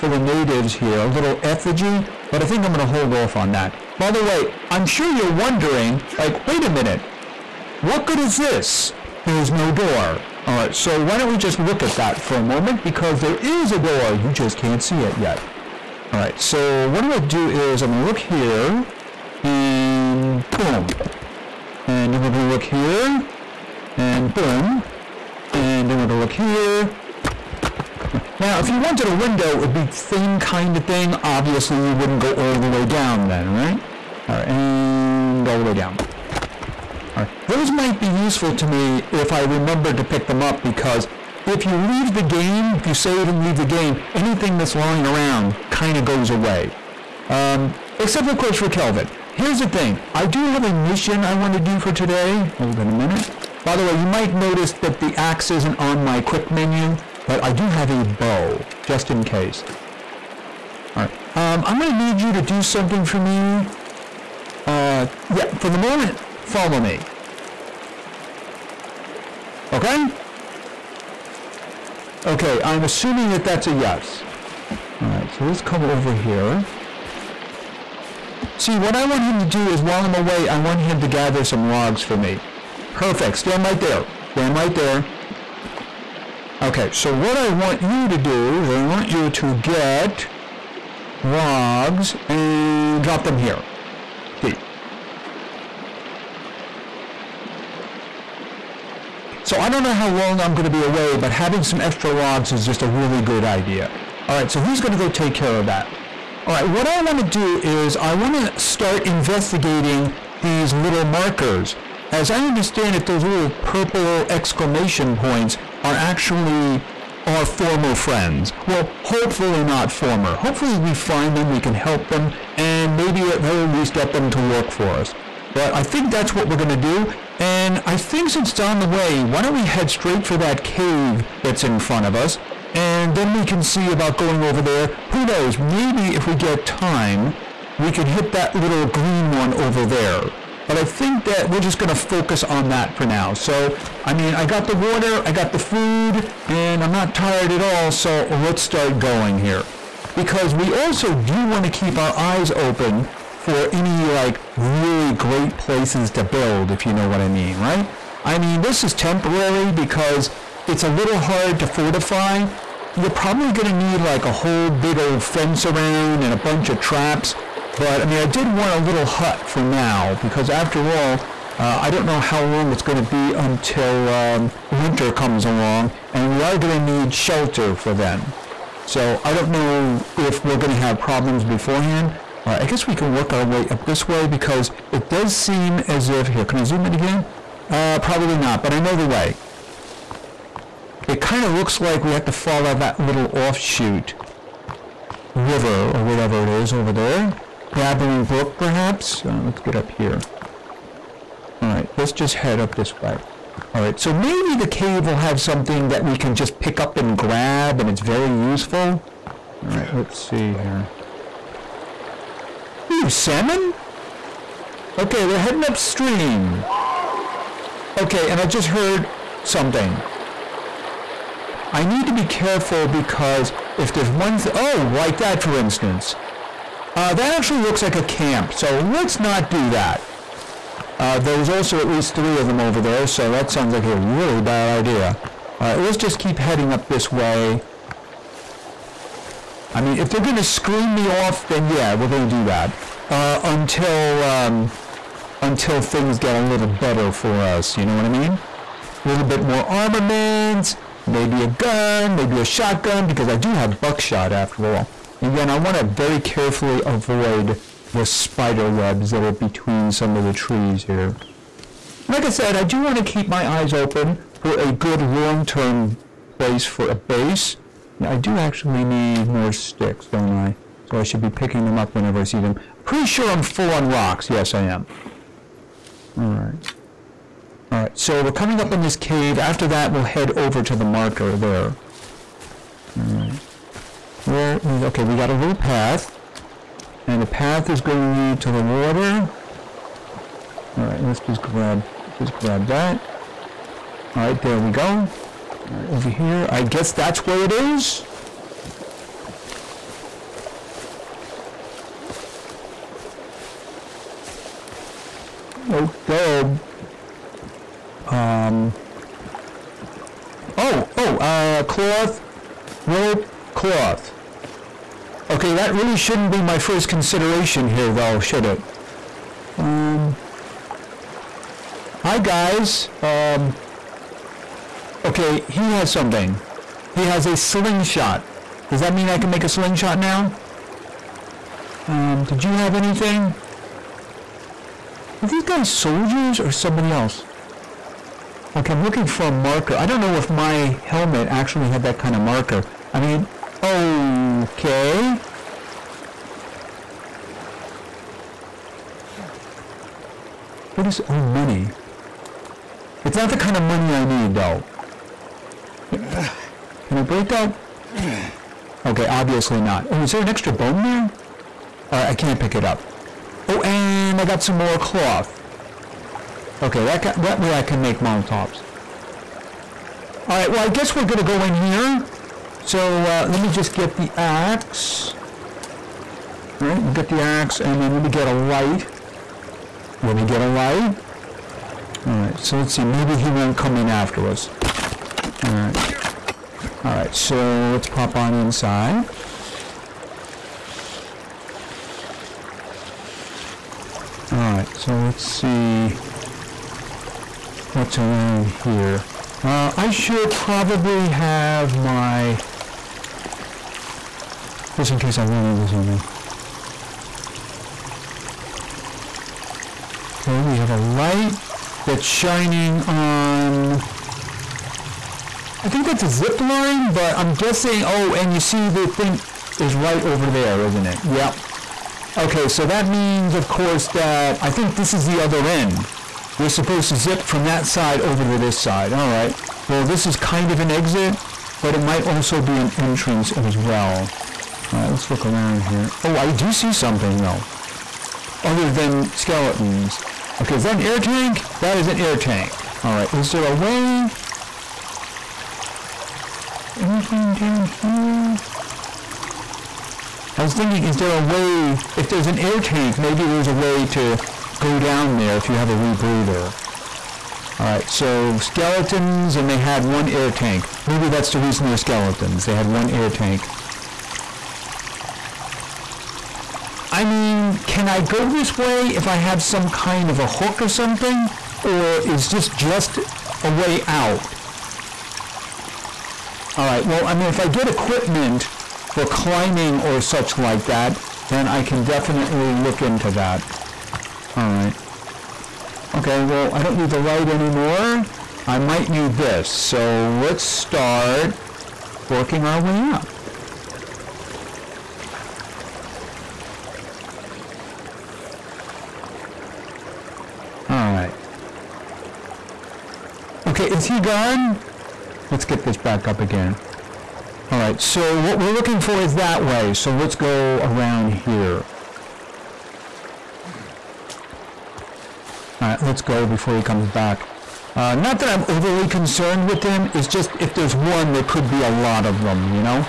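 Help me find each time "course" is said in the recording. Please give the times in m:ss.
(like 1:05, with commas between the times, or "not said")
0:48, 7:03.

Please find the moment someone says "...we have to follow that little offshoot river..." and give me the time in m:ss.
3:12.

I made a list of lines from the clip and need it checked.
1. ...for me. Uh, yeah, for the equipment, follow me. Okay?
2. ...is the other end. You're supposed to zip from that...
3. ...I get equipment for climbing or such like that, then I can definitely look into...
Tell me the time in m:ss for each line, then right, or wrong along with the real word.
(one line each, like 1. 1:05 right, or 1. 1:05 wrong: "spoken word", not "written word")
1. 1:03 wrong: "moment", not "equipment"
2. 7:04 right
3. 7:57 right.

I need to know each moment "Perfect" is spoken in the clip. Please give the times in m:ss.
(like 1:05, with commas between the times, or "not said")
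1:22.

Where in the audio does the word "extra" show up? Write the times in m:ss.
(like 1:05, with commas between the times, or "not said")
1:41, 6:00.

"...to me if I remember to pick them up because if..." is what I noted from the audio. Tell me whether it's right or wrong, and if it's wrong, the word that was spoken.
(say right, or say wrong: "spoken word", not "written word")
right.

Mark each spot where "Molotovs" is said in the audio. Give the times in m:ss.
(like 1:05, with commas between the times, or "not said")
6:07.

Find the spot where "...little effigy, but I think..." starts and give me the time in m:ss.
0:01.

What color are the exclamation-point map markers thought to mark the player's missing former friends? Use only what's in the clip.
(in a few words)
purple.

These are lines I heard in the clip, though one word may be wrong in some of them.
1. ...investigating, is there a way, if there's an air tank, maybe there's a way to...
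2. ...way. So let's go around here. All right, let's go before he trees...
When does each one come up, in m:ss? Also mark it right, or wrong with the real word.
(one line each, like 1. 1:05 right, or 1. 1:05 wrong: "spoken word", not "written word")
1. 7:30 wrong: "thinking", not "investigating"
2. 8:29 wrong: "comes", not "trees".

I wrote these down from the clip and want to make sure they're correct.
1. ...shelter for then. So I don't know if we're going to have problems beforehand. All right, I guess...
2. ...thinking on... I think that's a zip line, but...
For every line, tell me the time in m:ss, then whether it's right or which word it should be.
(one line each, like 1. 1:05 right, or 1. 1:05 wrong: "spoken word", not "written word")
1. 2:57 right
2. 6:52 wrong: "shining", not "thinking".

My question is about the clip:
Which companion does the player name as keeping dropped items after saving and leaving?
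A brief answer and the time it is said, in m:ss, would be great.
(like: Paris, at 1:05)
Kelvin, at 0:48.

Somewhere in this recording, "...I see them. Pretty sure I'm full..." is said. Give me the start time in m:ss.
4:32.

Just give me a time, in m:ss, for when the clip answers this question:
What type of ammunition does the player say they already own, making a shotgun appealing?
4:13.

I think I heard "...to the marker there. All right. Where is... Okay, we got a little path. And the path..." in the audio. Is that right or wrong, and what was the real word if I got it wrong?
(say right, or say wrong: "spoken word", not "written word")
right.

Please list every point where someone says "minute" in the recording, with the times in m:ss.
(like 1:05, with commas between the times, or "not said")
0:06, 0:52.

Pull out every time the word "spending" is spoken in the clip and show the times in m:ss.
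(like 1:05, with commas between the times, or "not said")
not said.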